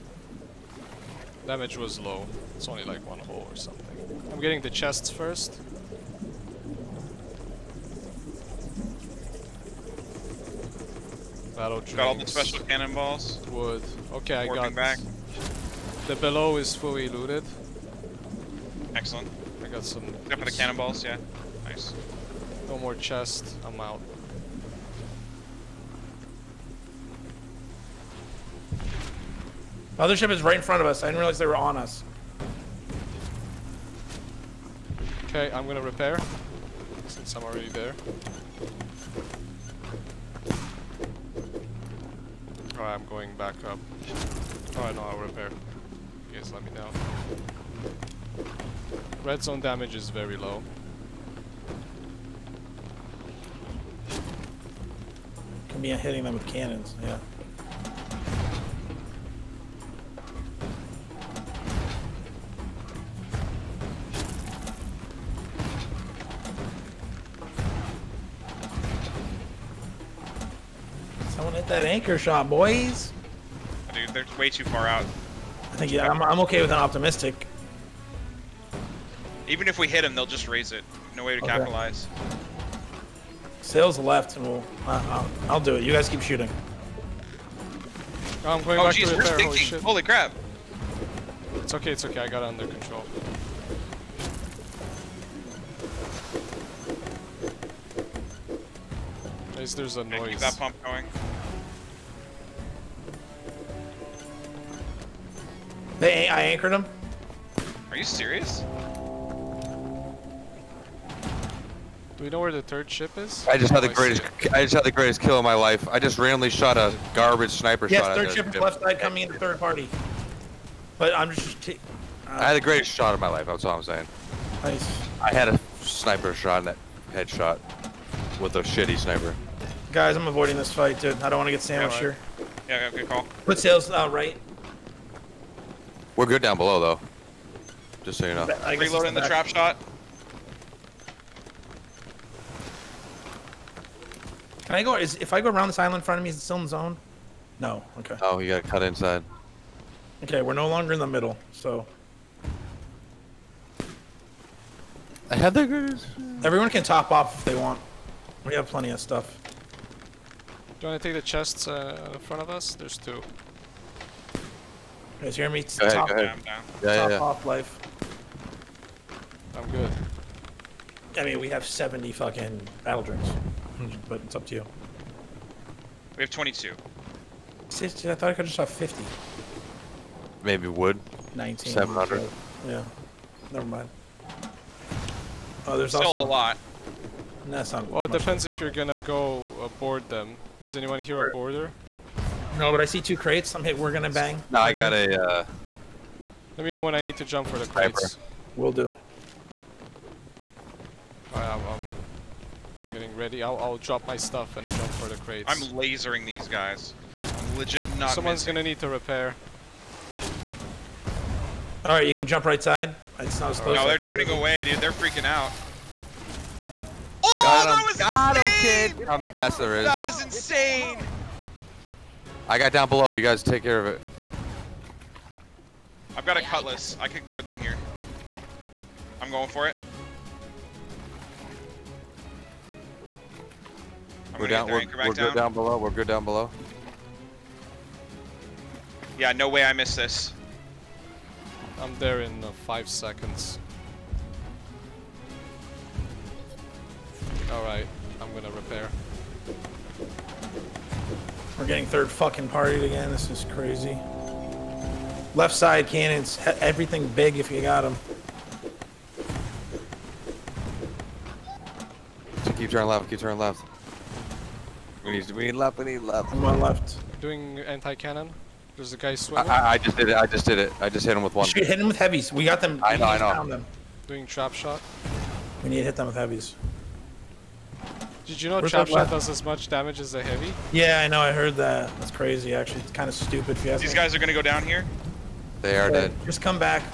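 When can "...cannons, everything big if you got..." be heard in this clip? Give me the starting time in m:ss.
4:15.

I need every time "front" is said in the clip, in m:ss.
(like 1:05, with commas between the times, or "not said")
0:30, 2:26, 2:42.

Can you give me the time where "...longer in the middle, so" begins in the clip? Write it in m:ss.
2:30.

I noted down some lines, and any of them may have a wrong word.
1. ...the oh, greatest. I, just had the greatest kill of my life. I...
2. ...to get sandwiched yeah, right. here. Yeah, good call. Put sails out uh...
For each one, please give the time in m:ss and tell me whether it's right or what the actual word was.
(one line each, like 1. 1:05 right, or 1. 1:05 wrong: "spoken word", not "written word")
1. 1:53 right
2. 2:11 right.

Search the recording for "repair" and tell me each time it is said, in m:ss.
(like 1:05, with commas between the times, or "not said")
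0:35, 0:45, 3:28, 4:08.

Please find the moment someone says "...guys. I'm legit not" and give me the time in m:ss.
3:26.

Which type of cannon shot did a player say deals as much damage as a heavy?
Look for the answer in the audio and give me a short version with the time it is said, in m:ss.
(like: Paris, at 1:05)
Chop Shot, at 4:38.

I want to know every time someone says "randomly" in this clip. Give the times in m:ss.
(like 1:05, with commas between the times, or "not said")
1:56.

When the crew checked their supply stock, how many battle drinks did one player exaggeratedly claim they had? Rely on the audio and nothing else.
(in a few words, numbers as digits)
70.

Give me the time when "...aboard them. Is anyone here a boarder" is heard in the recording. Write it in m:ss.
3:09.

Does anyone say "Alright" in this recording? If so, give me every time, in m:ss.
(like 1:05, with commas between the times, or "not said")
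3:21, 3:31.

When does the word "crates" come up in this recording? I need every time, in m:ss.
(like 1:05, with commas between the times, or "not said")
3:13, 3:17, 3:25.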